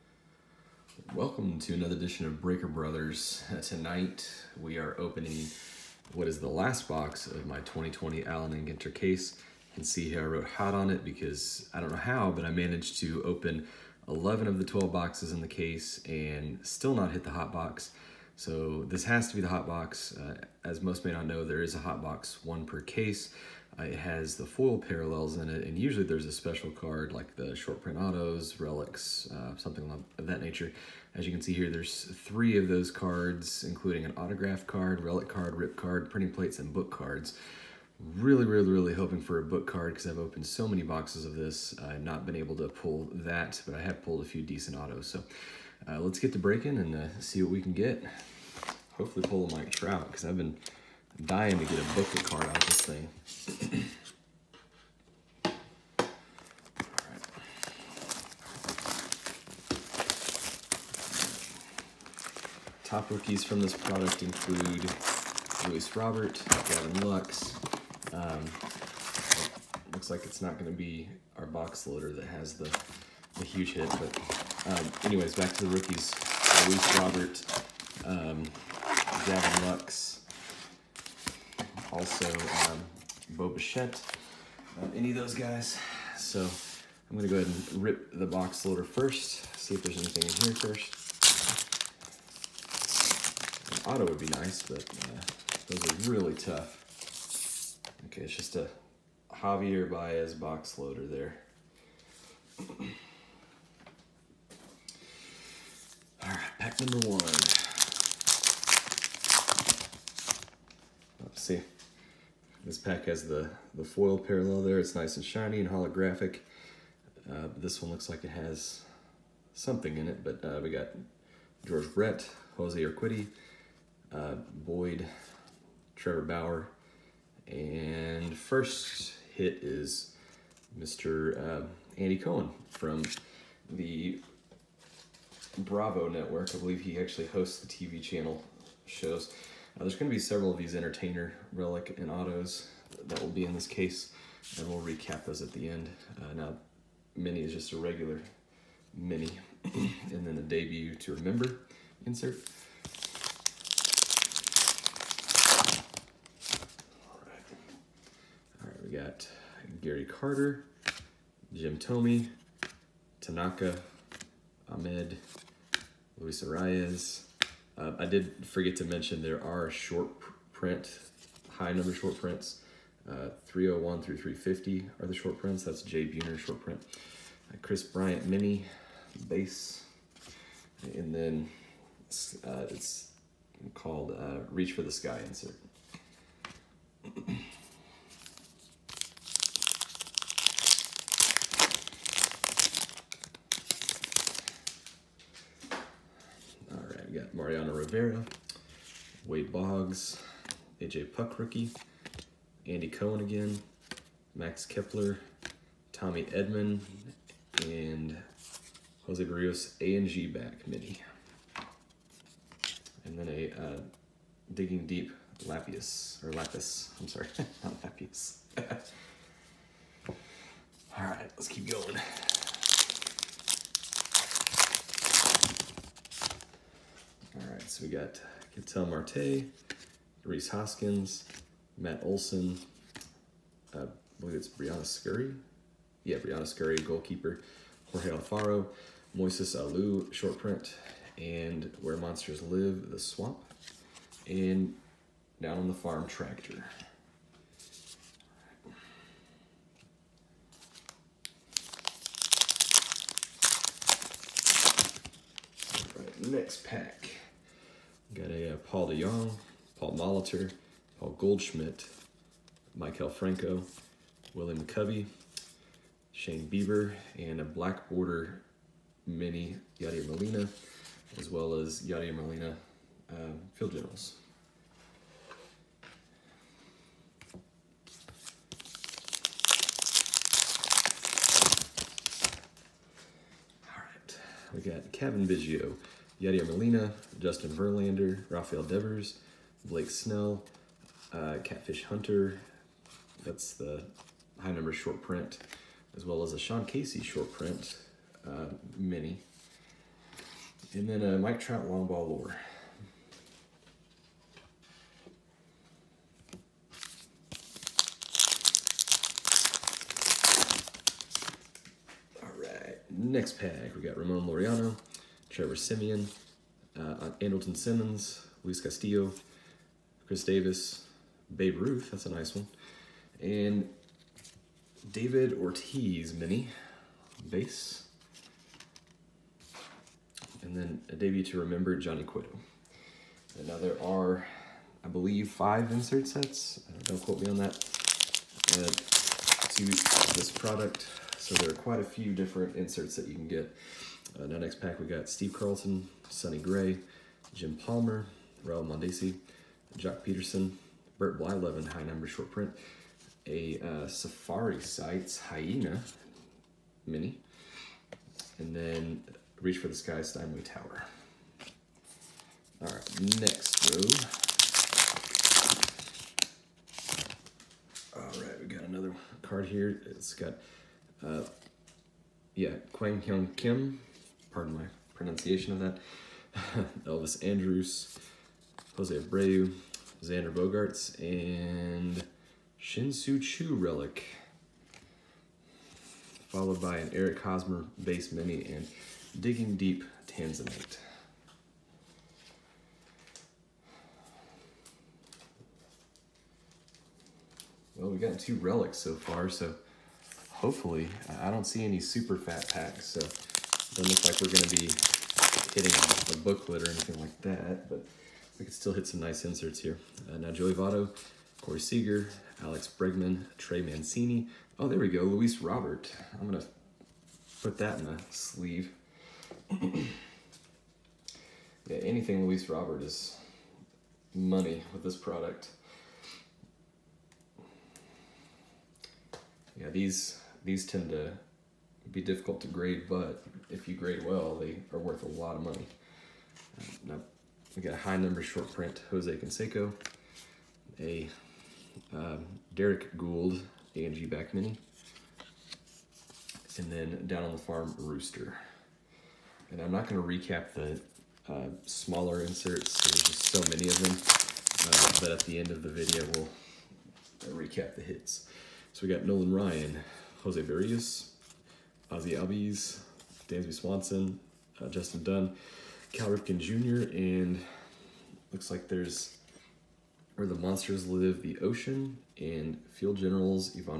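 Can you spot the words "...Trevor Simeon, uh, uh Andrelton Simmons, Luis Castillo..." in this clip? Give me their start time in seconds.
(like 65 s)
315 s.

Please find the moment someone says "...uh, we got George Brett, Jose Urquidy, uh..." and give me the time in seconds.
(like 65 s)
120 s.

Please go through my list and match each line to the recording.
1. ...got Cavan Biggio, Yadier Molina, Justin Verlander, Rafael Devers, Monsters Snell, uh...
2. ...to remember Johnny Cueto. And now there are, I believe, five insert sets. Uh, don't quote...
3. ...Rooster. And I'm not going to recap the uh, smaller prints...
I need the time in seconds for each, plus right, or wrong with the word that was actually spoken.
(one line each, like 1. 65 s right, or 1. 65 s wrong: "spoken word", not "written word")
1. 284 s wrong: "Blake", not "Monsters"
2. 331 s right
3. 447 s wrong: "inserts", not "prints".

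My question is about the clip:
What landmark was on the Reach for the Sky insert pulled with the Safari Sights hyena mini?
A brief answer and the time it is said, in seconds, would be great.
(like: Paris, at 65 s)
Steinway Tower, at 360 s.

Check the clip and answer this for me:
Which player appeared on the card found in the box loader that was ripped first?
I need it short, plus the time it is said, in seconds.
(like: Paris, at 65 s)
Javier Baez, at 99 s.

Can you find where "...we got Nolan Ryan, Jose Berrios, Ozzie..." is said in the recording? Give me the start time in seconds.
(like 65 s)
458 s.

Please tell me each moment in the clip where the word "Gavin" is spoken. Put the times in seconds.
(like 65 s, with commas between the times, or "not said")
66 s, 79 s.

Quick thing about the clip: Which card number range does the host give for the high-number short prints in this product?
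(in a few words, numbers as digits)
301 through 350.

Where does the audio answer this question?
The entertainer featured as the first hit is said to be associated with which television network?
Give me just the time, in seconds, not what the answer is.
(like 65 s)
135 s.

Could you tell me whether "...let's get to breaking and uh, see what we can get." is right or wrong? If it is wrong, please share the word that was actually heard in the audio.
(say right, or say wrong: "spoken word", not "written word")
right.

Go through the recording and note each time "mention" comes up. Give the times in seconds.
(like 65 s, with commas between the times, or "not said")
168 s.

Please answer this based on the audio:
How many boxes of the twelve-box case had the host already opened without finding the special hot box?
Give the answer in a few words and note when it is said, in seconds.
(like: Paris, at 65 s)
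11, at 14 s.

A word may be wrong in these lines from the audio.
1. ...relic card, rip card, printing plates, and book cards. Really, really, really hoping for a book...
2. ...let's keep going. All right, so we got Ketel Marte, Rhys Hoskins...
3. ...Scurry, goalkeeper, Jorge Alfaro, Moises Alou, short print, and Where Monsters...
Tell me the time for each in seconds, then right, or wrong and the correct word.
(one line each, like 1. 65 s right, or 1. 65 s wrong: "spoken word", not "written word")
1. 35 s right
2. 221 s right
3. 236 s right.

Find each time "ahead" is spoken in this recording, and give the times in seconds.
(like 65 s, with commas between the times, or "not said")
87 s.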